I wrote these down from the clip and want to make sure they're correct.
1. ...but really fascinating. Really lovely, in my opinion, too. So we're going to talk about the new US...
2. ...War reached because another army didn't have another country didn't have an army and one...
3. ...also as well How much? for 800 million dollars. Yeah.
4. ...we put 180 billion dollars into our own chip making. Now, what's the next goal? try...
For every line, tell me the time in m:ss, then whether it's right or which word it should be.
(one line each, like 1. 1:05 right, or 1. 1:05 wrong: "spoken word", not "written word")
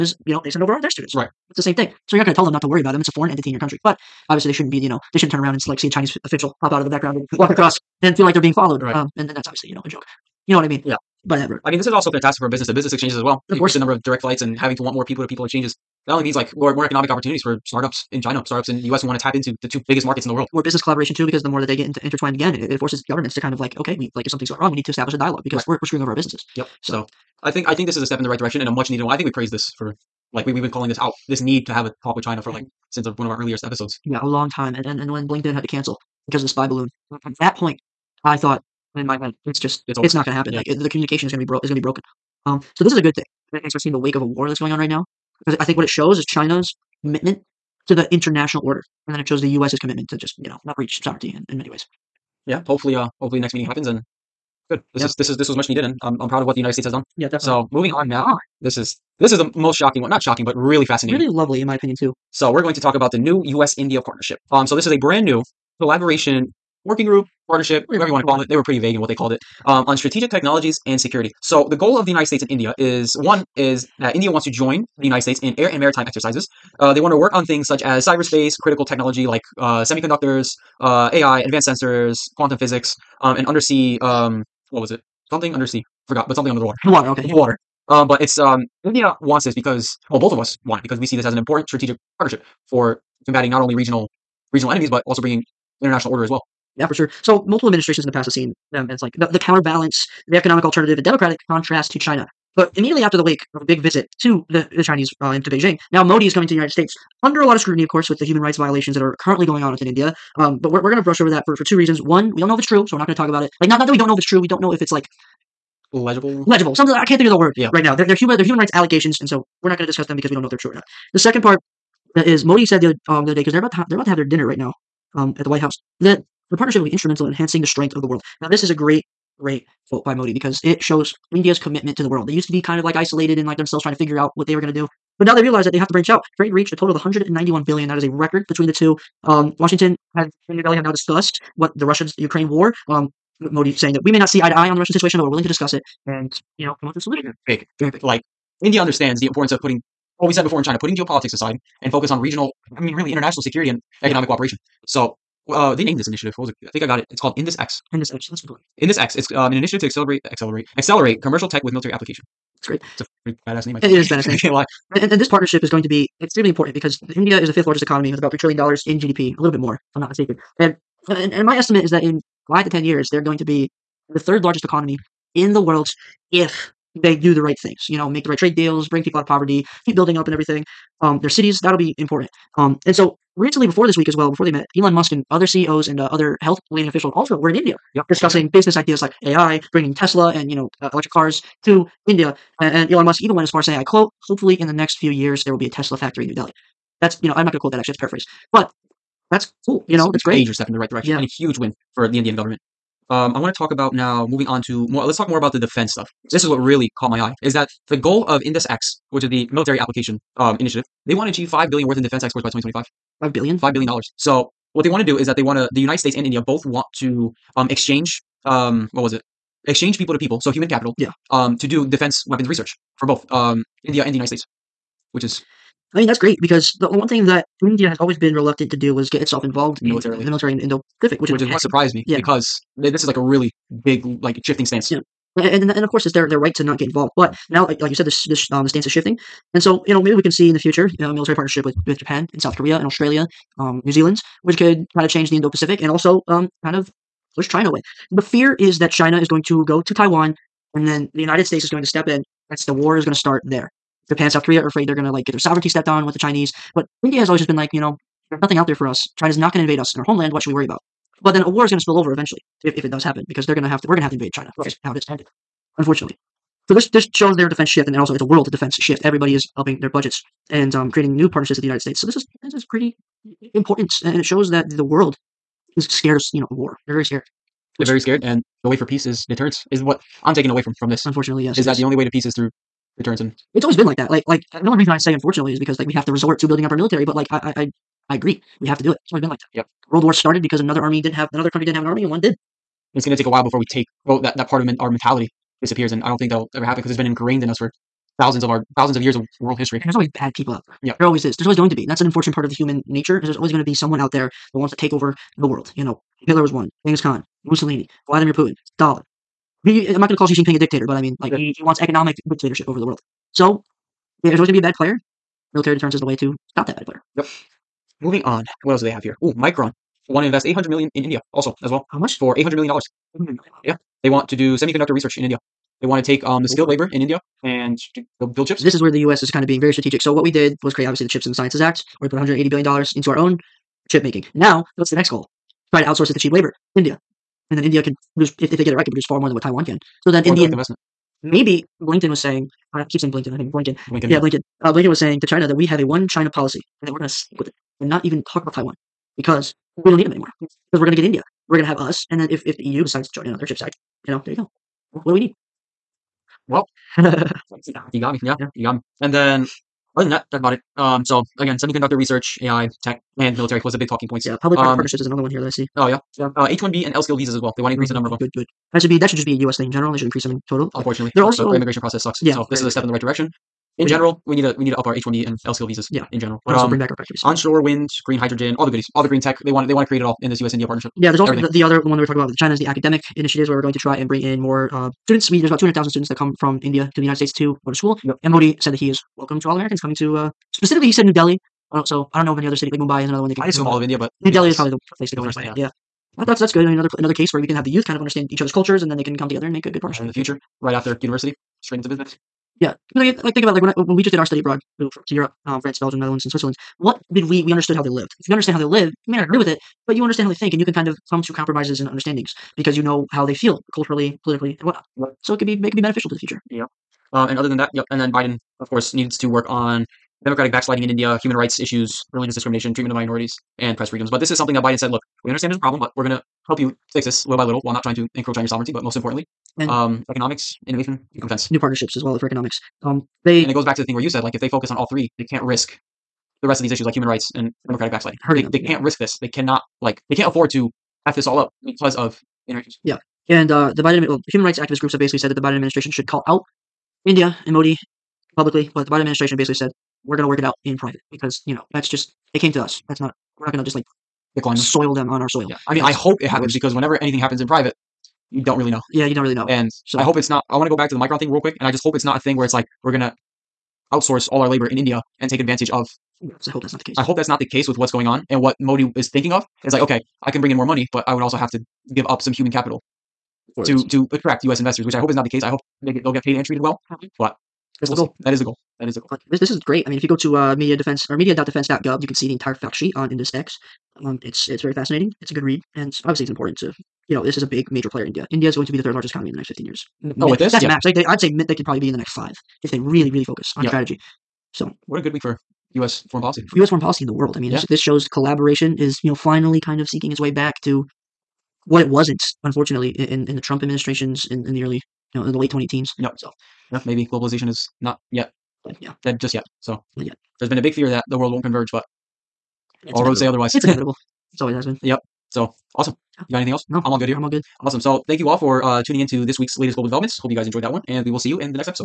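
1. 1:00 right
2. 4:50 wrong: "started", not "reached"
3. 5:21 right
4. 5:32 right.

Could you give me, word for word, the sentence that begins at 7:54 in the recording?
investors, which I hope is not the case.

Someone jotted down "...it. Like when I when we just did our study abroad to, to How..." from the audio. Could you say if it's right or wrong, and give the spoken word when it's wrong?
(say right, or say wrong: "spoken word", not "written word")
wrong: "Europe", not "How".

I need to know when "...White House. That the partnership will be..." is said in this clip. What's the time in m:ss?
2:05.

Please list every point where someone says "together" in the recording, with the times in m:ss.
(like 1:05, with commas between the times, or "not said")
6:39.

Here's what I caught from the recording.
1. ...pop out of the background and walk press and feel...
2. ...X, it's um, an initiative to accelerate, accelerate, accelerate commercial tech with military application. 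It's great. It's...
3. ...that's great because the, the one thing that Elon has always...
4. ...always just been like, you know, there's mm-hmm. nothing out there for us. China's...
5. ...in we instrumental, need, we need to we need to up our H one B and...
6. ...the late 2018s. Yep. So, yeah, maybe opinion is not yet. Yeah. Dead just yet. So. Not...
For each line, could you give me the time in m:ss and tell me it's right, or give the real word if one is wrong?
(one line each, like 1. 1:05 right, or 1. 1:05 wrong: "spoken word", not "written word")
1. 0:06 wrong: "across", not "press"
2. 2:38 right
3. 3:46 wrong: "India", not "Elon"
4. 4:17 right
5. 6:13 wrong: "general", not "instrumental"
6. 8:25 wrong: "globalization", not "opinion".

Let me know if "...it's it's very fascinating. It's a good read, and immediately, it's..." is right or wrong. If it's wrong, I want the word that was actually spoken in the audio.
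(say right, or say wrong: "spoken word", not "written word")
wrong: "obviously", not "immediately".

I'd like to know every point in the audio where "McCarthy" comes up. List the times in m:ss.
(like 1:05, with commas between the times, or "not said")
not said.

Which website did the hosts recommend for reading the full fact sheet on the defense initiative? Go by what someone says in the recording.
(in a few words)
media.defense.gov.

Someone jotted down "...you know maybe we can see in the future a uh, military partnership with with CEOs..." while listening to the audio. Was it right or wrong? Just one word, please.
wrong.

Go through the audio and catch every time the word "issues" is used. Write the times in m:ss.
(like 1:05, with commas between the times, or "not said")
7:01, 7:16.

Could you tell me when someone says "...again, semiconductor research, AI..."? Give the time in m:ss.
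6:01.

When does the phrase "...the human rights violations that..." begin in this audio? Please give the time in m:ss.
1:48.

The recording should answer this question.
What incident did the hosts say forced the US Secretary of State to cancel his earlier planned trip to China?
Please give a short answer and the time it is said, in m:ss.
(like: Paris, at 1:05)
The spy balloon, at 0:36.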